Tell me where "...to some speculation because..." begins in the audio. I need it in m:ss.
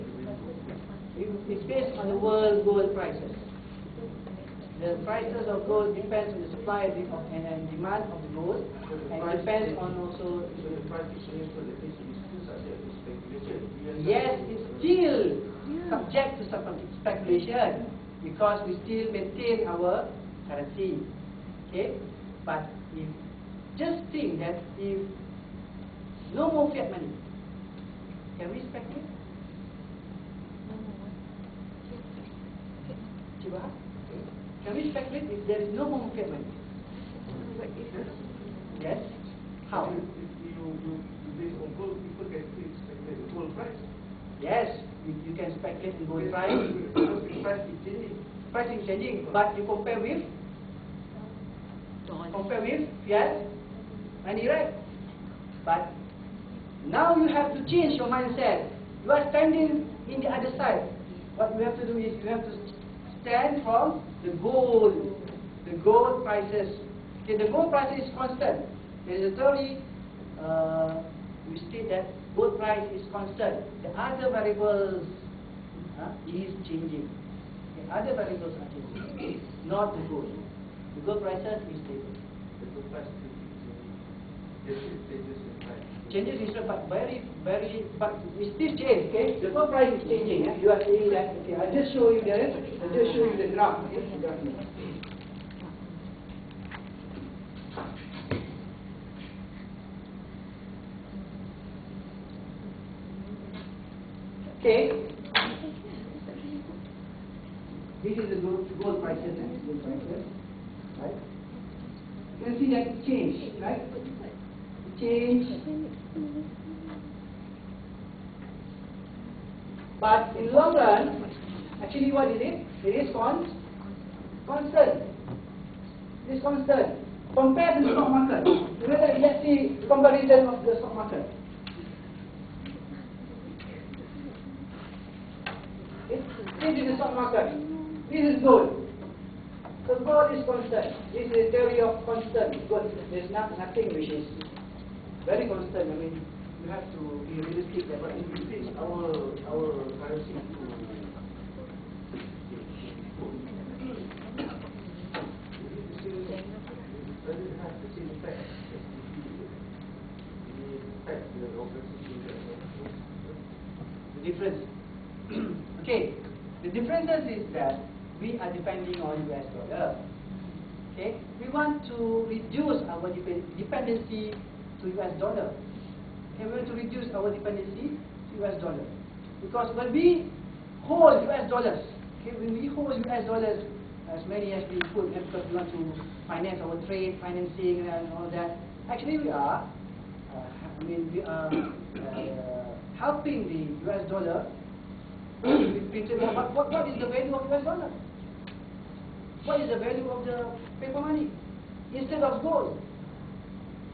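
0:16.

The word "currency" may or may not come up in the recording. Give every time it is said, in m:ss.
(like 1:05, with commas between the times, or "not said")
0:20, 2:30.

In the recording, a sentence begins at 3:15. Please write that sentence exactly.
what, what is the value of US dollar?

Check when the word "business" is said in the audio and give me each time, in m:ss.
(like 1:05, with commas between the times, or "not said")
0:11.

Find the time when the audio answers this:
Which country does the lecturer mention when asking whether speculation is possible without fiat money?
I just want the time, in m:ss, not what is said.
0:33.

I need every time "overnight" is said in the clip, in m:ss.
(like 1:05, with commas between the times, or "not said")
not said.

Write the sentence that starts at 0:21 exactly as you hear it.
Okay, but if just think that if no more fiat money, can we speculate?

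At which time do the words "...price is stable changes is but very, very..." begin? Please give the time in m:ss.
1:22.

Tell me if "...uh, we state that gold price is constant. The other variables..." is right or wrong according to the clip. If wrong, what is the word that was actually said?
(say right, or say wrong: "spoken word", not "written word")
right.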